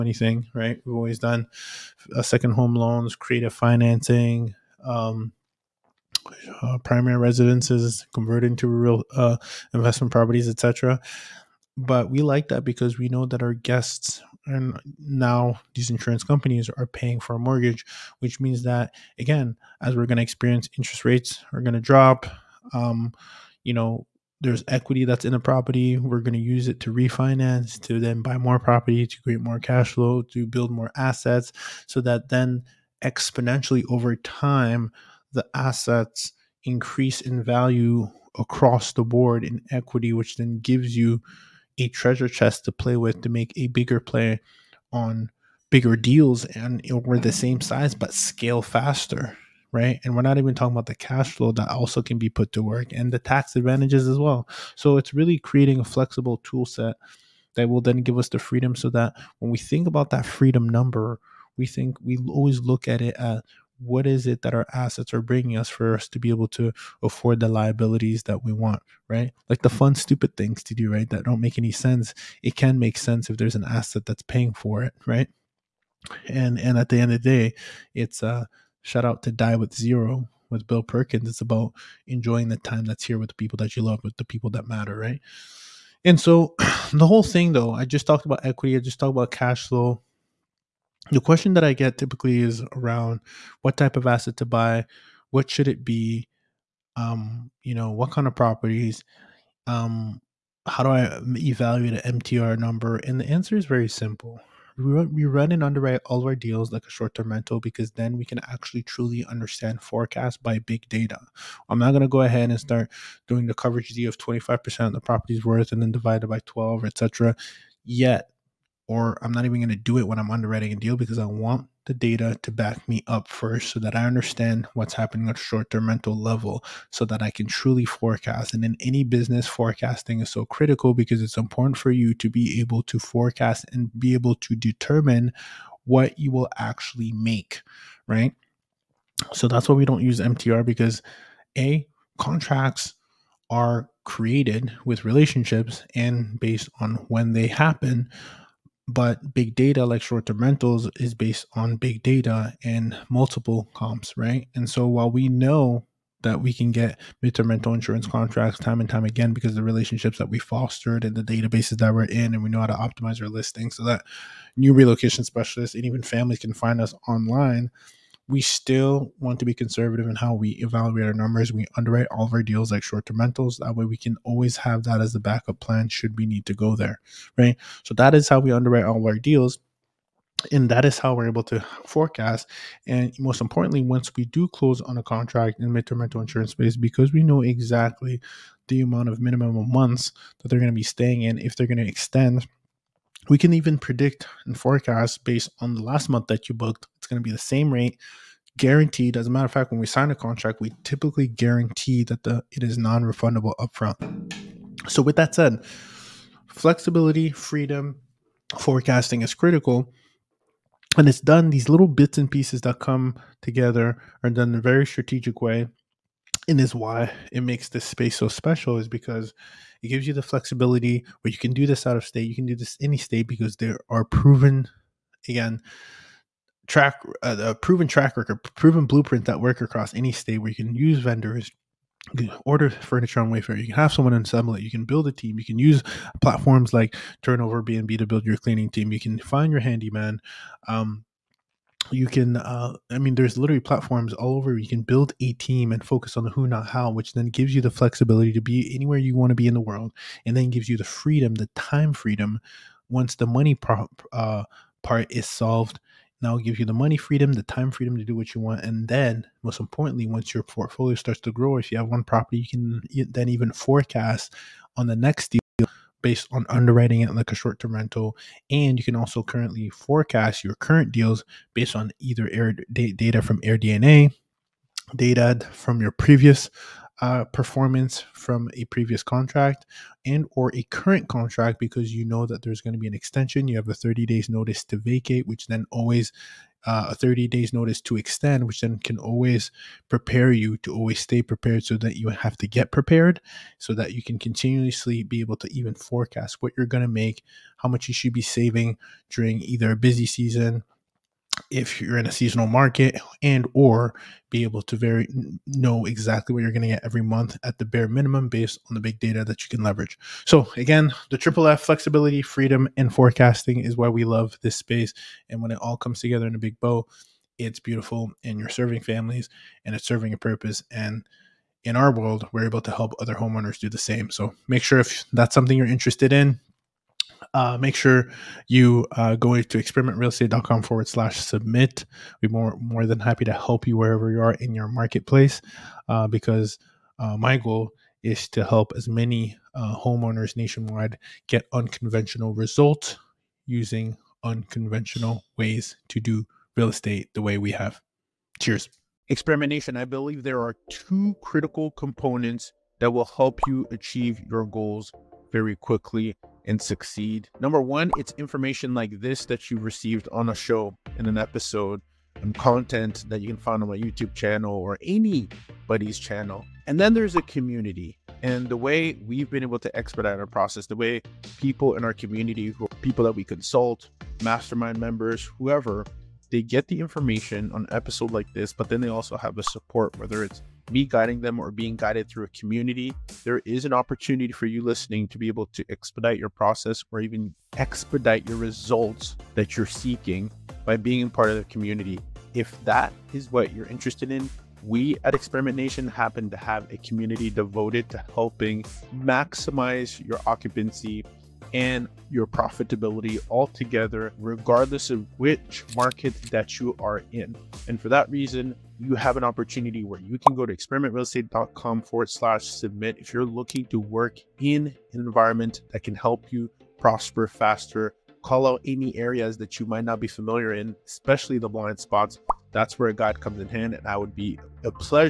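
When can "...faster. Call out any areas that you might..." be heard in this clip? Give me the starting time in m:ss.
6:57.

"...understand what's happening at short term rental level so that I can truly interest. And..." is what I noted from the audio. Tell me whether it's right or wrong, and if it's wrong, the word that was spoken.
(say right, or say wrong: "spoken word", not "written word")
wrong: "forecast", not "interest".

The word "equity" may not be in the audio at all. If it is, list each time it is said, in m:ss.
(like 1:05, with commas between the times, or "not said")
0:24, 0:39, 1:28.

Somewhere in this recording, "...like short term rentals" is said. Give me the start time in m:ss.
2:52.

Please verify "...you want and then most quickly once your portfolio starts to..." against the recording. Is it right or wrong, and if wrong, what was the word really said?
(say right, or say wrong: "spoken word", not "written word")
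wrong: "importantly", not "quickly".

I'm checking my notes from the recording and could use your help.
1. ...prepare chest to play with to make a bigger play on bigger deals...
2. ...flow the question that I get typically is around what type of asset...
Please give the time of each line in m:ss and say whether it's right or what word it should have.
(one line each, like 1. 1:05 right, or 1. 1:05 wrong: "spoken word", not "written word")
1. 0:41 wrong: "treasure", not "prepare"
2. 1:29 right.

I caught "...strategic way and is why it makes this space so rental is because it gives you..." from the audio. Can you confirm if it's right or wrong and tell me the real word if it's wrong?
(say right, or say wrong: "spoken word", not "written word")
wrong: "special", not "rental".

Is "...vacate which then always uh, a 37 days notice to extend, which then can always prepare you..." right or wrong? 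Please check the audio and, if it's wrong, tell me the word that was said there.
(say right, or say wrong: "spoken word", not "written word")
wrong: "30", not "37".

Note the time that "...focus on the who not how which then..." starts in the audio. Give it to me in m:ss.
4:05.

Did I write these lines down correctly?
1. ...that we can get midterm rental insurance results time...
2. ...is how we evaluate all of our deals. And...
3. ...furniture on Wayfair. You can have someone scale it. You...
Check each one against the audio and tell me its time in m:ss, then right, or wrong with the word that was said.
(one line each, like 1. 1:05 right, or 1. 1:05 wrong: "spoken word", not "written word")
1. 2:36 wrong: "contracts", not "results"
2. 2:58 wrong: "underwrite", not "evaluate"
3. 3:52 wrong: "assemble", not "scale".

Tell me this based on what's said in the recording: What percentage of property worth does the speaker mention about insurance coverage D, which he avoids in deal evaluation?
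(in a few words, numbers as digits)
25%.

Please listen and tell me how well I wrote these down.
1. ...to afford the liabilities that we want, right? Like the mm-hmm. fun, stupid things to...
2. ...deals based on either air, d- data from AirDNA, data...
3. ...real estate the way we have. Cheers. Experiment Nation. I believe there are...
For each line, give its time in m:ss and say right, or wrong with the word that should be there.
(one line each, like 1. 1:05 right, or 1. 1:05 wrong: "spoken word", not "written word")
1. 1:06 right
2. 4:30 right
3. 5:46 right.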